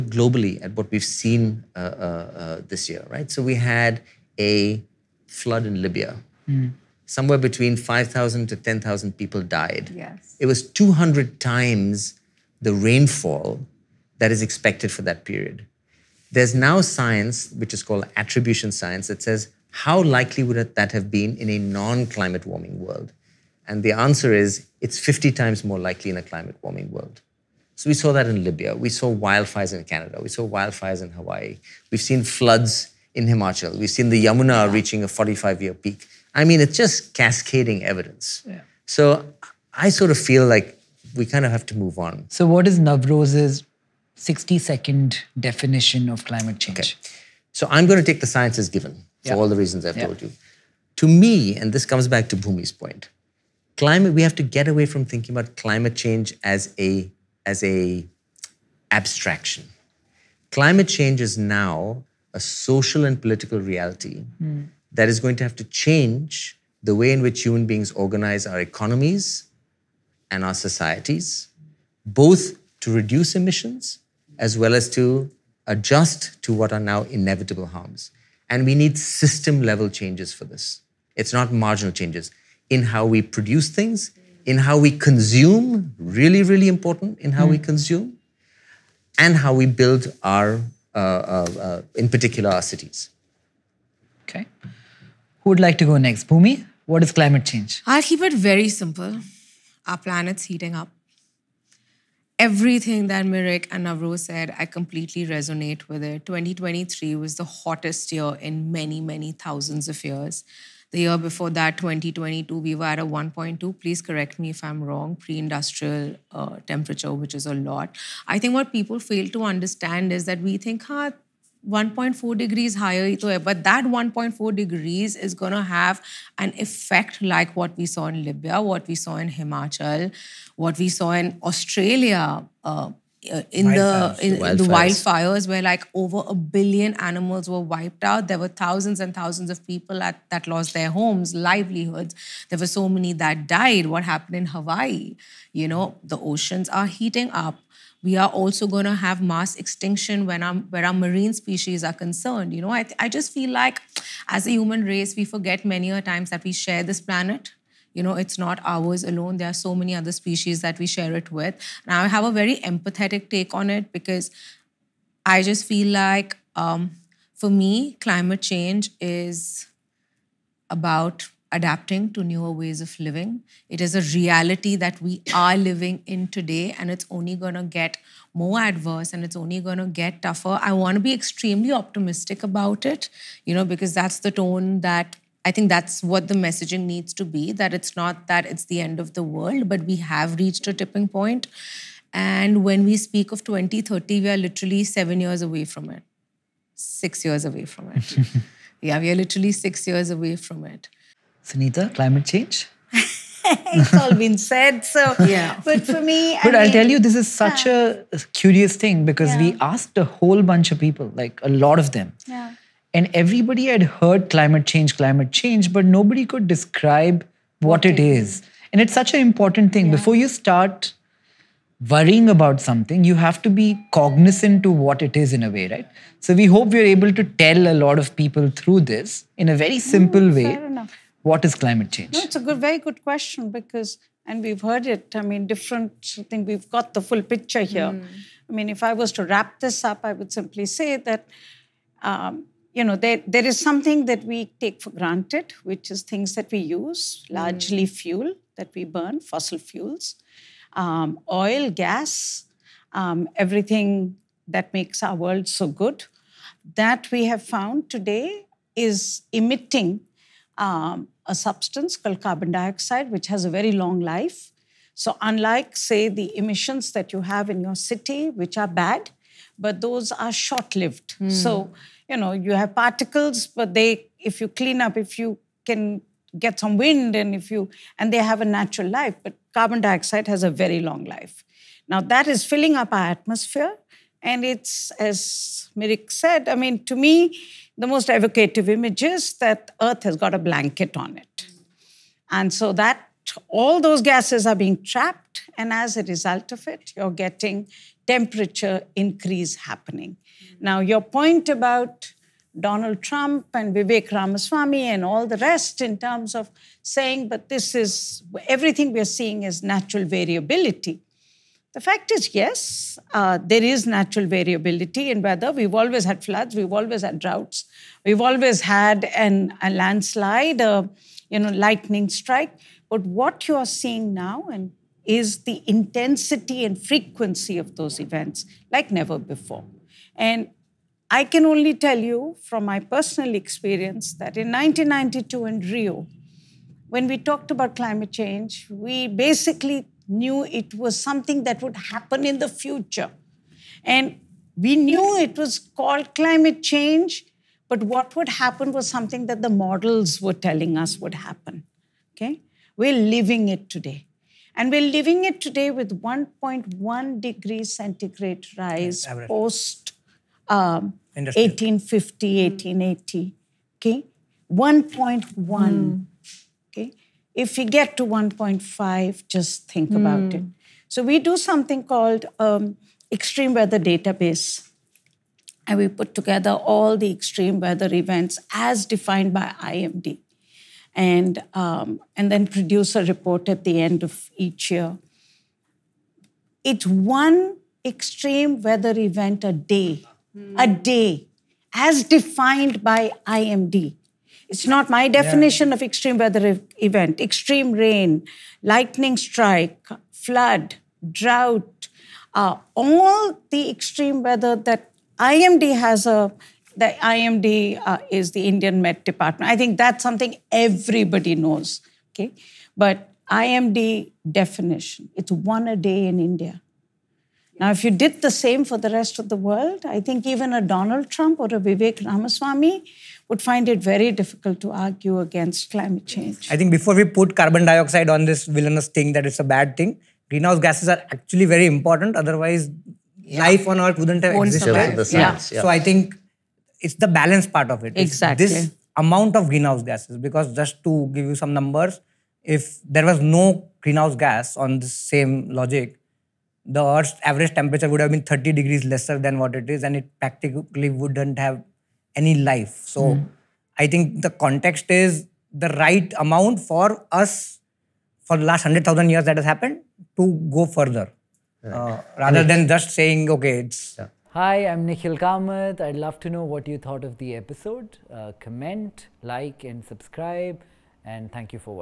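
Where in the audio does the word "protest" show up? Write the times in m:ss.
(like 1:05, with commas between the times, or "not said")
not said.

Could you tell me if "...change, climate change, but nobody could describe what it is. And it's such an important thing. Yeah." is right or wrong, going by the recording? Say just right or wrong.
right.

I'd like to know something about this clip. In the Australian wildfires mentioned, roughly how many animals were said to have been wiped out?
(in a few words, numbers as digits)
over a billion.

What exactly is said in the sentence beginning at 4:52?
And so that all those gases are being trapped.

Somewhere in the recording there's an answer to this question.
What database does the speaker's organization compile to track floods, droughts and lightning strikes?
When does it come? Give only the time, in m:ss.
6:13.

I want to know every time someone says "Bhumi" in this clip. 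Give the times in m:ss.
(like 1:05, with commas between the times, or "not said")
0:52, 1:36.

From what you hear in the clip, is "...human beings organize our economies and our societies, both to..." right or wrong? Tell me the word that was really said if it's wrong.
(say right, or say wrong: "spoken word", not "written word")
right.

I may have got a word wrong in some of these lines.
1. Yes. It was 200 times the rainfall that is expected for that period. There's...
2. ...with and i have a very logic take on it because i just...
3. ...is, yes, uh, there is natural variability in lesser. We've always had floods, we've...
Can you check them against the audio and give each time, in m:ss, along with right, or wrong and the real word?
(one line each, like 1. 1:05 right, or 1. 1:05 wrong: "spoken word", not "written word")
1. 0:09 right
2. 2:41 wrong: "empathetic", not "logic"
3. 5:12 wrong: "weather", not "lesser".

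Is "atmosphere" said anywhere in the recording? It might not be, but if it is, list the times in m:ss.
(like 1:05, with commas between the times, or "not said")
4:43.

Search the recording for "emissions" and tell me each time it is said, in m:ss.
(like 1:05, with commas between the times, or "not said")
1:13, 4:26.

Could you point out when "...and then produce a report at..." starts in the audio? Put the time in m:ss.
6:22.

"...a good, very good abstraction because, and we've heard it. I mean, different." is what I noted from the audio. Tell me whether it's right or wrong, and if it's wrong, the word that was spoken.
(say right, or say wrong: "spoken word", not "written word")
wrong: "question", not "abstraction".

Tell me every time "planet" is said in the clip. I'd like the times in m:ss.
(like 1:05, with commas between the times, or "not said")
1:39, 2:36.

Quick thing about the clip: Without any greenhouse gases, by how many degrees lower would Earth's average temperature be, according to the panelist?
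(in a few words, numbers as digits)
30 degrees.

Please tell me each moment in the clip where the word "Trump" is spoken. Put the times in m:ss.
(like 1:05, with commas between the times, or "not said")
5:03, 7:01.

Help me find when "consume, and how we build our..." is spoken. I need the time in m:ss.
1:27.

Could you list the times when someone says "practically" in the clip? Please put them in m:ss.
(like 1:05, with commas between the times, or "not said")
7:30.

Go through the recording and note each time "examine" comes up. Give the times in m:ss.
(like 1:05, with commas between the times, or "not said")
not said.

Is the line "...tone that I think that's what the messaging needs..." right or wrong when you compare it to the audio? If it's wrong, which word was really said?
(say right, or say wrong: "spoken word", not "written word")
right.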